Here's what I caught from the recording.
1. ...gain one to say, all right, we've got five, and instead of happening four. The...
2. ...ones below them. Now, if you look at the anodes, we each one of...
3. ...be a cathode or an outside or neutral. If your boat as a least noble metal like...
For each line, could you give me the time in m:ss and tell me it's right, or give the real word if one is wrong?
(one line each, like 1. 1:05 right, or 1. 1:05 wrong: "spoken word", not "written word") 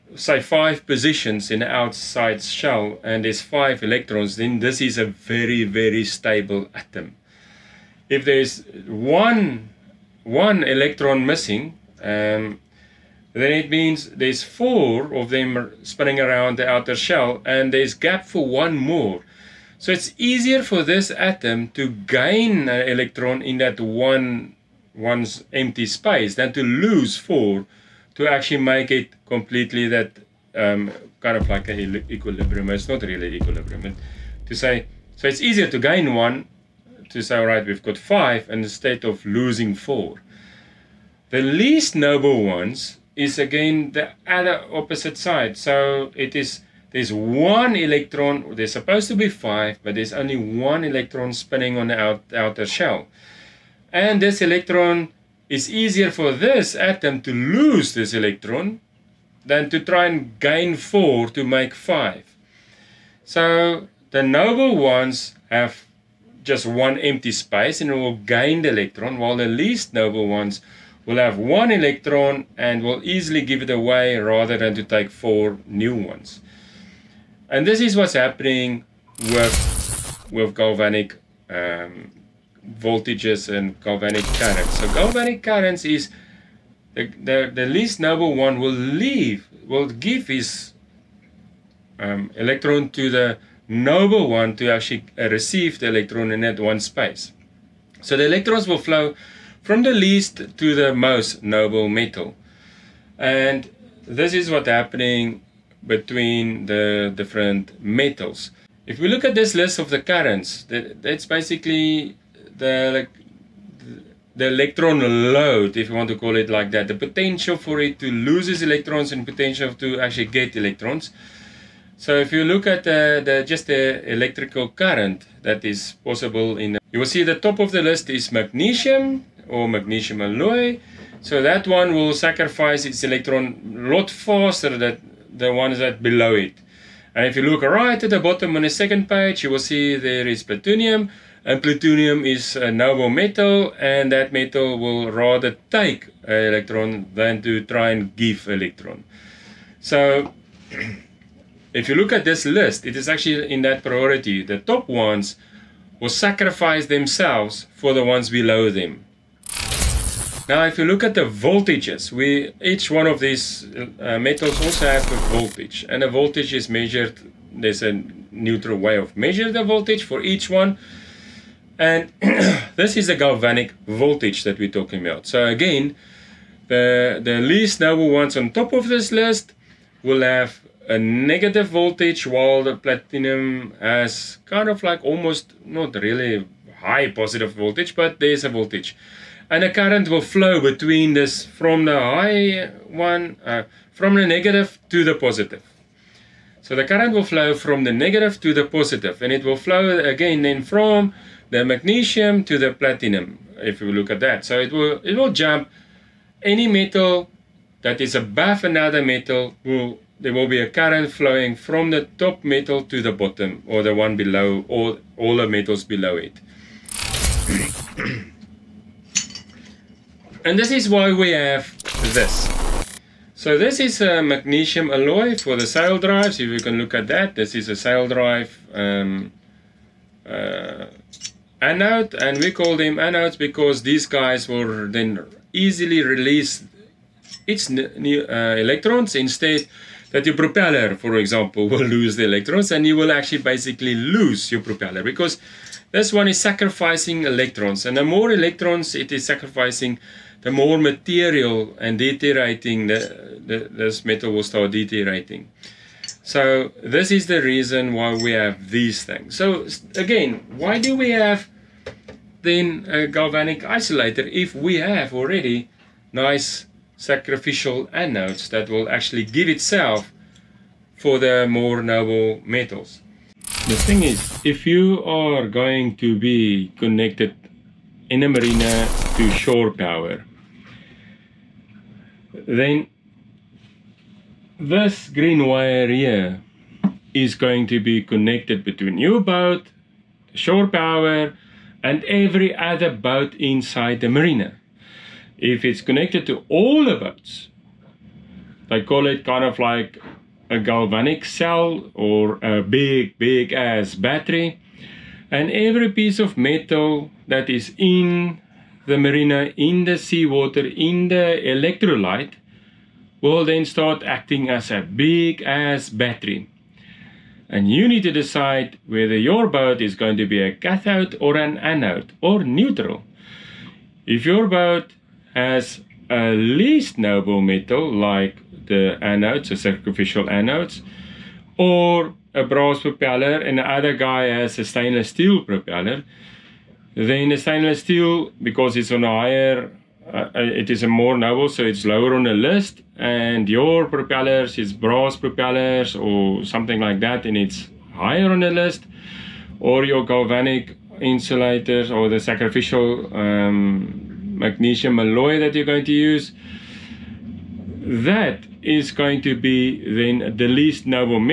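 1. 0:35 wrong: "losing", not "happening"
2. 2:38 wrong: "voltages", not "anodes"
3. 5:20 wrong: "anode", not "outside".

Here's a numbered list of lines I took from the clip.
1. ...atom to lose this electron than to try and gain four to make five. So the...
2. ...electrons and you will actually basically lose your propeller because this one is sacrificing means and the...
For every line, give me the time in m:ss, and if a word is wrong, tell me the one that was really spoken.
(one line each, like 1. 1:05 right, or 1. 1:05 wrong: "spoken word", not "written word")
1. 0:56 right
2. 4:02 wrong: "electrons", not "means".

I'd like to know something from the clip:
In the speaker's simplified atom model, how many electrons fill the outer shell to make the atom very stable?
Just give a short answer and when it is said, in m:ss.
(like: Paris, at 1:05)
5, at 0:03.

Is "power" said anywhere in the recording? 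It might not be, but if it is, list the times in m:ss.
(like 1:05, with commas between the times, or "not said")
4:39, 4:50.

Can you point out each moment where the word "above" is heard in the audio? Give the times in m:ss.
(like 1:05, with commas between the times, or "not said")
3:28.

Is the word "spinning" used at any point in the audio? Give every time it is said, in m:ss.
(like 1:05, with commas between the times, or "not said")
0:15, 0:51.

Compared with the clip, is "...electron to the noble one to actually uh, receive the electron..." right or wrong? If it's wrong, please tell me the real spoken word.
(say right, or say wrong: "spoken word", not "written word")
right.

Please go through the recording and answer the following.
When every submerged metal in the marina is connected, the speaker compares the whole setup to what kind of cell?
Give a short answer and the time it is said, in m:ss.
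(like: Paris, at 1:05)
galvanic cell, at 5:00.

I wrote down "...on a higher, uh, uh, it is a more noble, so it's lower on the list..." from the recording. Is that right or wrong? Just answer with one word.
right.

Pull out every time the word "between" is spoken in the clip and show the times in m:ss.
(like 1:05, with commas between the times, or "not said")
1:45, 3:10, 4:48.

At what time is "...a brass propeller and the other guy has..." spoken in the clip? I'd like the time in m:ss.
5:32.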